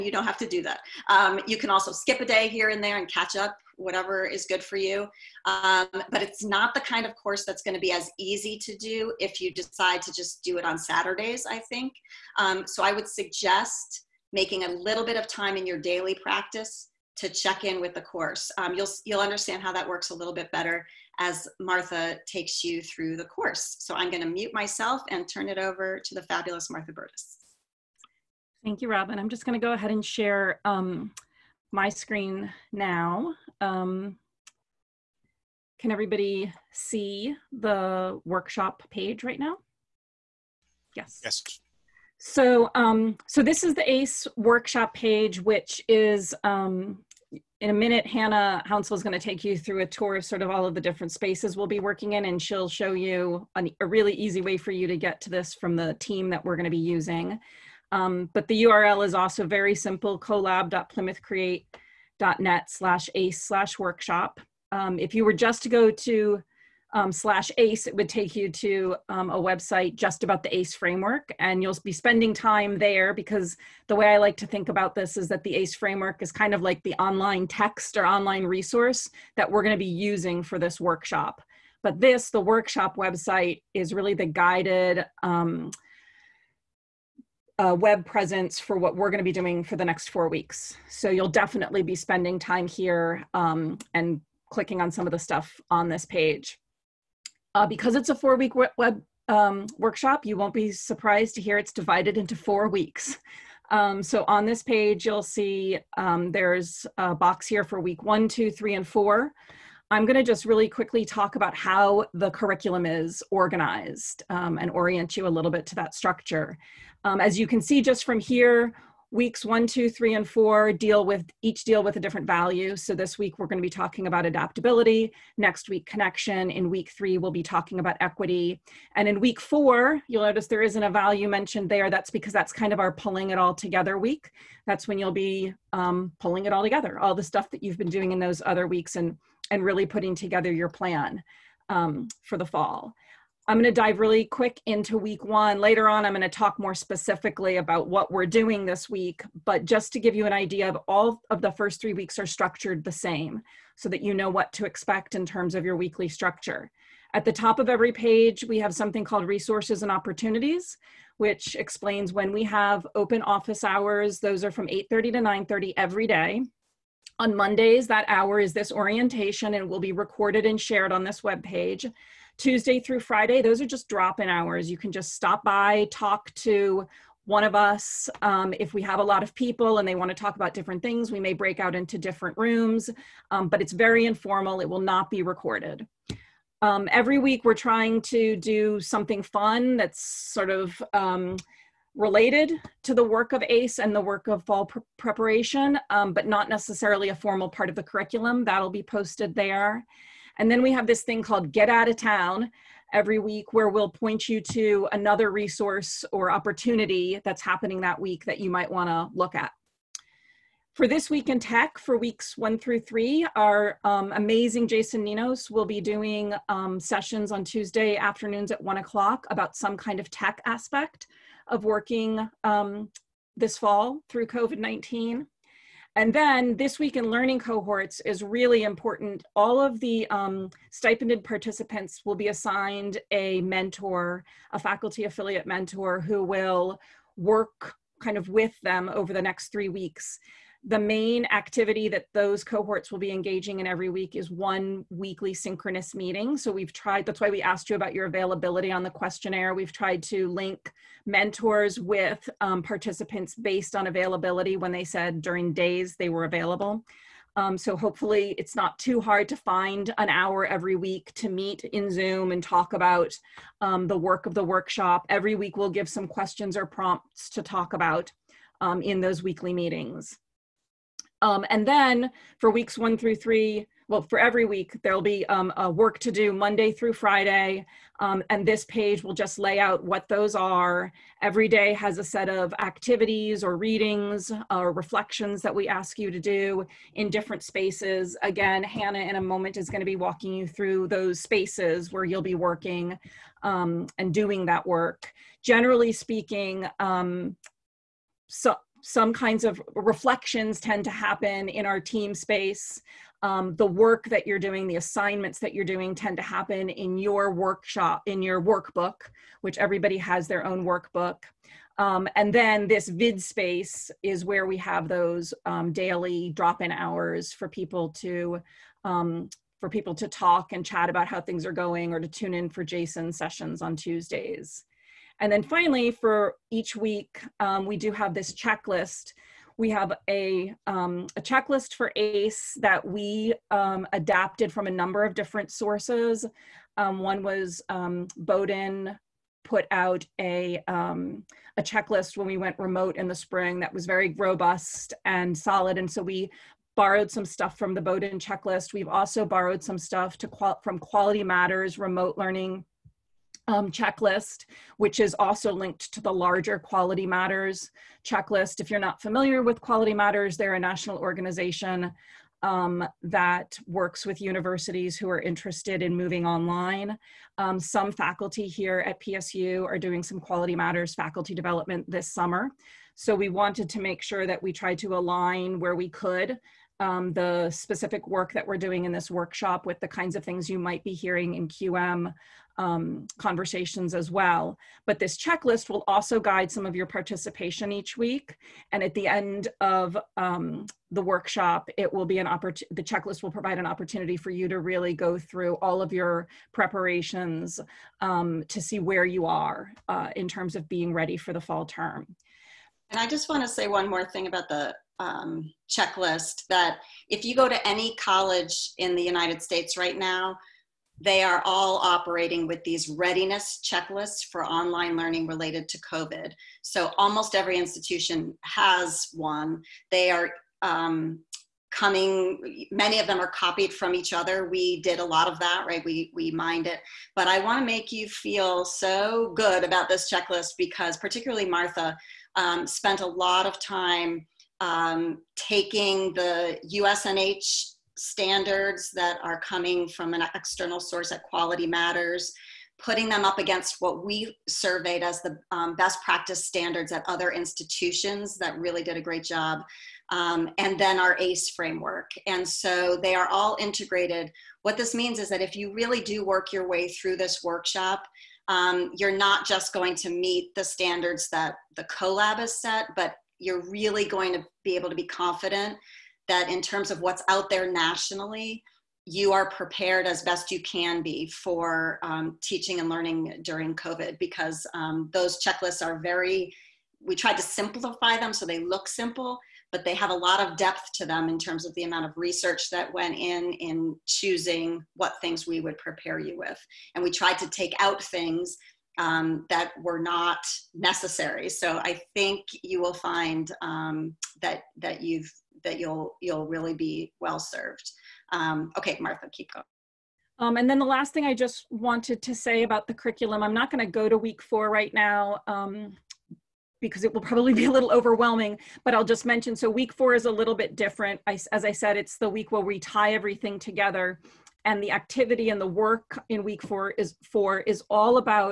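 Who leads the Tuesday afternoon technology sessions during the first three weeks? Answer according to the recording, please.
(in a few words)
Jason Ninos.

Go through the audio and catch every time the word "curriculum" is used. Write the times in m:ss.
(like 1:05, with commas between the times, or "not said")
1:52, 3:17, 8:22.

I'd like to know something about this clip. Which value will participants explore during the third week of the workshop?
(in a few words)
Equity.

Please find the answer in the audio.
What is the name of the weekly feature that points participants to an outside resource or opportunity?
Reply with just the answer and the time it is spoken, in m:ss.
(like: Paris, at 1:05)
Get Out of Town, at 3:21.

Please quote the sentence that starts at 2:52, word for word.
Tuesday through Friday, those are just drop in hours.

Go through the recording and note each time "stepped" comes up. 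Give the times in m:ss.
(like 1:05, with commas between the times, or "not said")
not said.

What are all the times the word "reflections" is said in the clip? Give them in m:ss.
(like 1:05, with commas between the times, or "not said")
4:44, 4:59.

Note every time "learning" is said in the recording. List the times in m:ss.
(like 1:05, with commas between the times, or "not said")
3:47, 5:52, 6:54, 7:52.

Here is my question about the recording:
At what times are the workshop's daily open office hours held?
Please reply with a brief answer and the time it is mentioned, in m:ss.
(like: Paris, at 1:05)
8:30 to 9:30, at 2:44.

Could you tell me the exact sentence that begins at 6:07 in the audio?
Um, some faculty here at PSU are doing some Quality Matters faculty development this summer.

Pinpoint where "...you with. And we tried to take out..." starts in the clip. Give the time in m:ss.
8:06.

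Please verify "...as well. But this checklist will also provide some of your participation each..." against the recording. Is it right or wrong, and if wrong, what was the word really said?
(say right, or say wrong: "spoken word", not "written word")
wrong: "guide", not "provide".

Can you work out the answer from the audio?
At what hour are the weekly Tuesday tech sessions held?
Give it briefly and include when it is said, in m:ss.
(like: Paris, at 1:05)
1 o'clock, at 3:38.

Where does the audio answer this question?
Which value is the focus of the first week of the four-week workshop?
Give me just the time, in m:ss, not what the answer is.
2:04.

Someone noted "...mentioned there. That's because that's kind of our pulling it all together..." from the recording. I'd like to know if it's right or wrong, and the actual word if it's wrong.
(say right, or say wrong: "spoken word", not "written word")
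right.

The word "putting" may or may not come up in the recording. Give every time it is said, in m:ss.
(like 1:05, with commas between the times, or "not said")
2:19, 7:22.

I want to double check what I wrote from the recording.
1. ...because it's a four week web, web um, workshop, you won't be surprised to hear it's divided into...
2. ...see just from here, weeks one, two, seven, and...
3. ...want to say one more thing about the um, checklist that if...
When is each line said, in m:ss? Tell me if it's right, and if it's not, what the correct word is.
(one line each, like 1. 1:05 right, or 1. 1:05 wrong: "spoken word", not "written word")
1. 1:37 right
2. 1:57 wrong: "three", not "seven"
3. 6:43 right.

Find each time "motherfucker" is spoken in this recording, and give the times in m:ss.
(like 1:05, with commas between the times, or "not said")
not said.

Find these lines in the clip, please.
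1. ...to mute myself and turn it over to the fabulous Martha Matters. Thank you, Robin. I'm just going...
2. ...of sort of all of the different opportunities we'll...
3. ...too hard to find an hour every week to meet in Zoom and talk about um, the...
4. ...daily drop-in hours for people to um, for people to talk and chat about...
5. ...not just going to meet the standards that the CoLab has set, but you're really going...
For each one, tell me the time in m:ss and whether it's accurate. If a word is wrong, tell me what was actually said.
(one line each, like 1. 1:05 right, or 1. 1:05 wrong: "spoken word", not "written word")
1. 0:24 wrong: "Burtis", not "Matters"
2. 0:50 wrong: "spaces", not "opportunities"
3. 4:18 right
4. 5:15 right
5. 7:39 right.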